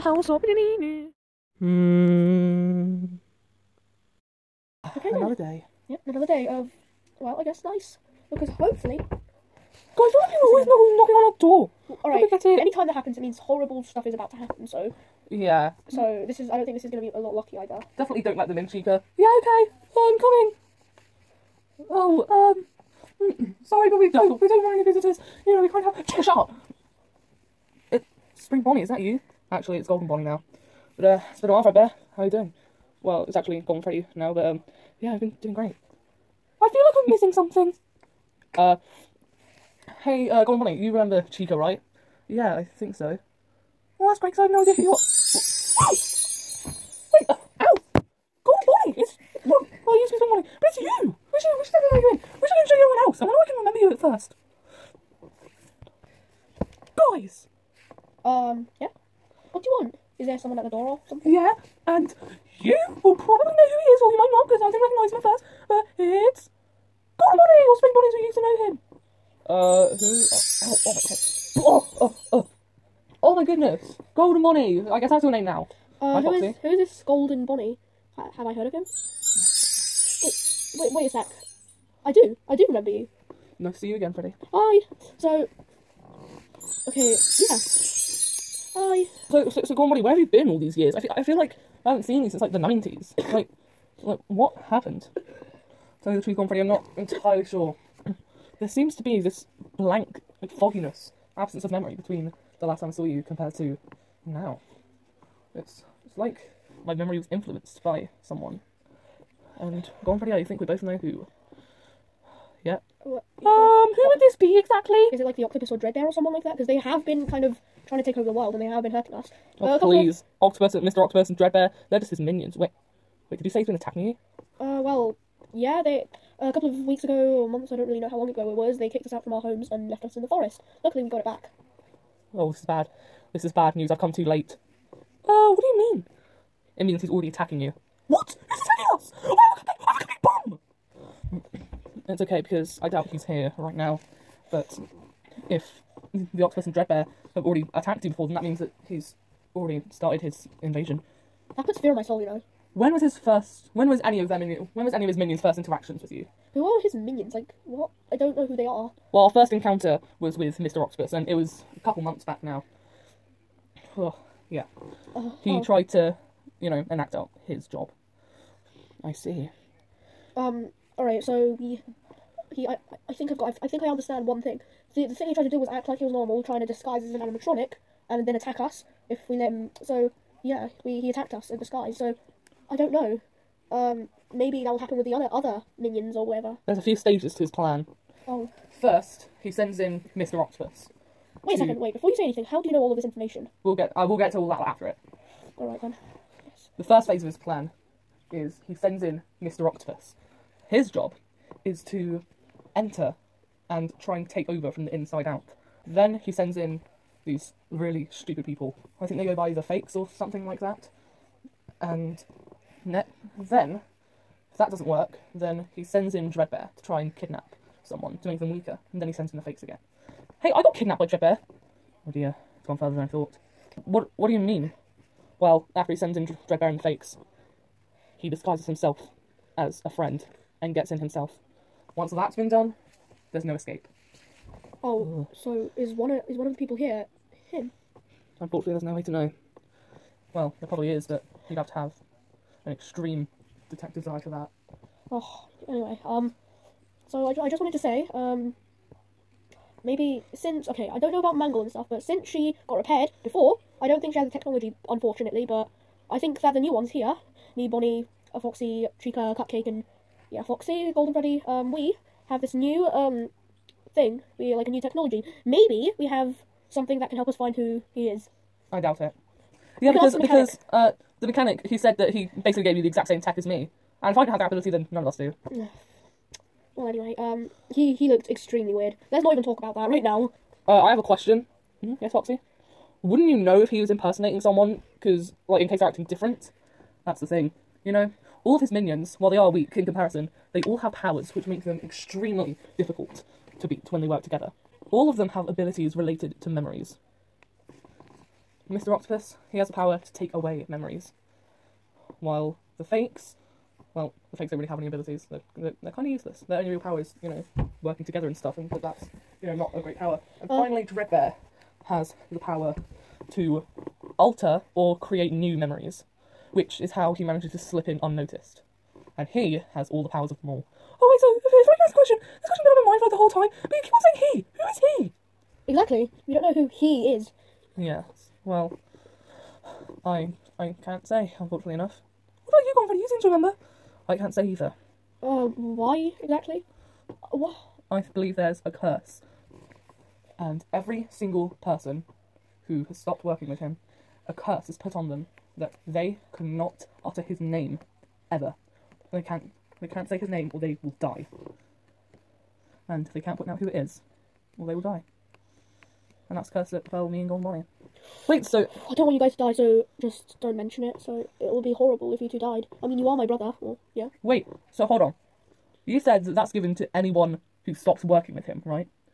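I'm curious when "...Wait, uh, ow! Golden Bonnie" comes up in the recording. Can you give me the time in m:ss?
0:47.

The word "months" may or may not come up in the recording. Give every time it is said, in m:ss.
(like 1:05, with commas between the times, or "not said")
2:07, 2:41.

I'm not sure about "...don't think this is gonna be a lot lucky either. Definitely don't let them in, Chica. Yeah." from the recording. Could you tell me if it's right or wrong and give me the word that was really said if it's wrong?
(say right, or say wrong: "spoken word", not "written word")
right.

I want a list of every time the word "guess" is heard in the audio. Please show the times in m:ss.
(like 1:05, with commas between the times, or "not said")
0:07, 1:14.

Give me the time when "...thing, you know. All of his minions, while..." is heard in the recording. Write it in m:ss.
4:47.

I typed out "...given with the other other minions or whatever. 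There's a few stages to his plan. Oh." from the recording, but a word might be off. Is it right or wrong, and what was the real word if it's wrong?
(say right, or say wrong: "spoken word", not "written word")
wrong: "happen", not "given".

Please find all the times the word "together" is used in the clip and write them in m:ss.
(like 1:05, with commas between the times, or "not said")
4:54, 5:08.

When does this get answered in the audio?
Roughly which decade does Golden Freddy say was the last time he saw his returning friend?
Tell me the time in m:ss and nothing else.
1:32.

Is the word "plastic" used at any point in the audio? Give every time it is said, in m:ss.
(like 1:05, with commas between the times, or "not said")
not said.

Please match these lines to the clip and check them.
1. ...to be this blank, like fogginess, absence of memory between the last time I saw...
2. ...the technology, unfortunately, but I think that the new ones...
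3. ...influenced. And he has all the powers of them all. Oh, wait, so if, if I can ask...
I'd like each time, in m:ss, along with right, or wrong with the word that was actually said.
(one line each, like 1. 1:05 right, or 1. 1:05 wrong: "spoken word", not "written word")
1. 1:38 right
2. 4:14 right
3. 5:18 wrong: "unnoticed", not "influenced".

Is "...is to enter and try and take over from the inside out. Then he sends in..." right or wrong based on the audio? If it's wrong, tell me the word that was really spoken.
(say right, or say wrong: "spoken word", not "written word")
right.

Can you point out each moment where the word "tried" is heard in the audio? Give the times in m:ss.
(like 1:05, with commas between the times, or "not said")
2:45, 2:55.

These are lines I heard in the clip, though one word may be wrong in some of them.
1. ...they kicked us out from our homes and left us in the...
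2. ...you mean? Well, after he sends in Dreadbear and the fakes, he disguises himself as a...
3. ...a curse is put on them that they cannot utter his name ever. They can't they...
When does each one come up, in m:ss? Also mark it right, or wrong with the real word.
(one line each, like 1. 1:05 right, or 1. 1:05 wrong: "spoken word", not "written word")
1. 2:08 right
2. 3:44 right
3. 5:44 right.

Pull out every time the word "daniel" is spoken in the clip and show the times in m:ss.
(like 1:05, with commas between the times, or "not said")
not said.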